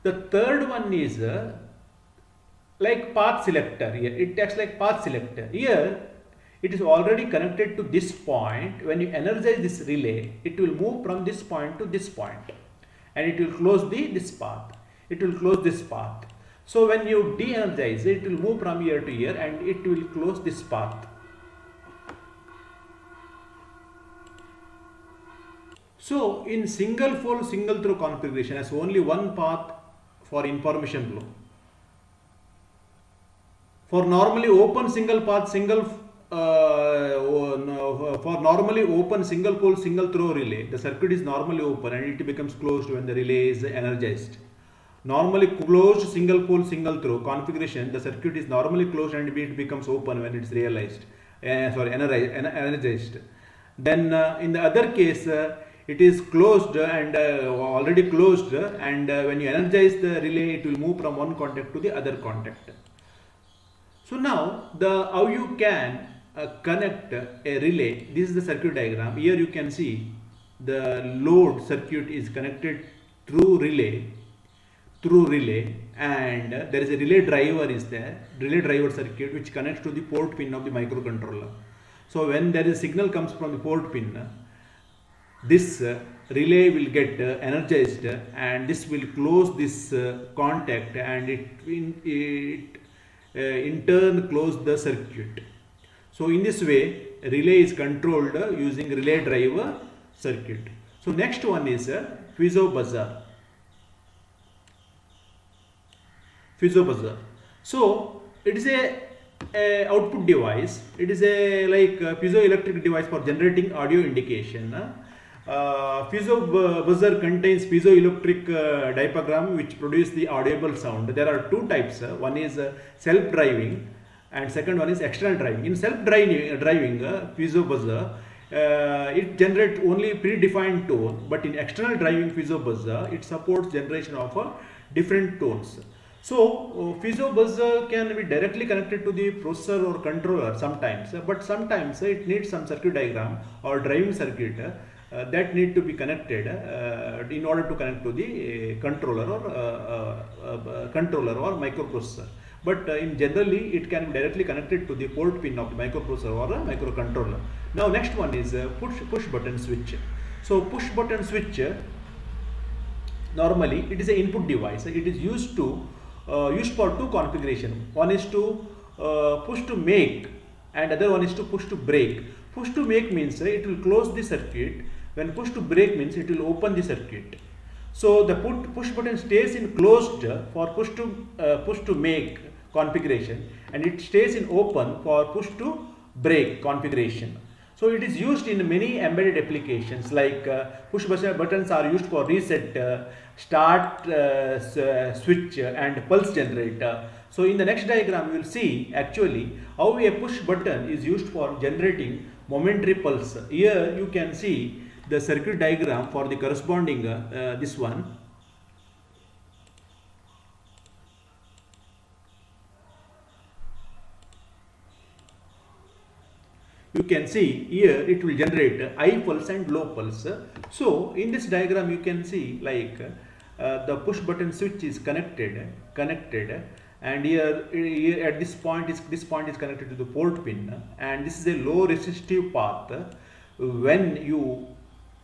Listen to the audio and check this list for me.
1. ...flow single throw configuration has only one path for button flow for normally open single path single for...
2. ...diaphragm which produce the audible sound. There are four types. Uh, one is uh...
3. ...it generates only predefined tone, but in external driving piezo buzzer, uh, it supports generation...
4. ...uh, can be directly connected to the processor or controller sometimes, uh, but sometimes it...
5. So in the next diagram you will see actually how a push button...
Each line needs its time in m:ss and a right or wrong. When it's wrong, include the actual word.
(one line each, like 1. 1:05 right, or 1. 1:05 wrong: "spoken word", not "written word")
1. 0:27 wrong: "information", not "button"
2. 1:58 wrong: "two", not "four"
3. 2:09 right
4. 2:17 right
5. 3:17 right.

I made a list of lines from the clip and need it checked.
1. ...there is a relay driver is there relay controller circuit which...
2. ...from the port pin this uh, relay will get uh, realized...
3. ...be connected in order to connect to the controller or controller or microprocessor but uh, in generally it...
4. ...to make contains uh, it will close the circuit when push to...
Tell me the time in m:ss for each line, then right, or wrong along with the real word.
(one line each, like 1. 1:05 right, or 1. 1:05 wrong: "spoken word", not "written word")
1. 1:16 wrong: "driver", not "controller"
2. 1:23 wrong: "energized", not "realized"
3. 2:25 right
4. 2:52 wrong: "means", not "contains".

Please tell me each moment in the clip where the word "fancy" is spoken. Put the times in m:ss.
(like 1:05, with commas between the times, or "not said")
not said.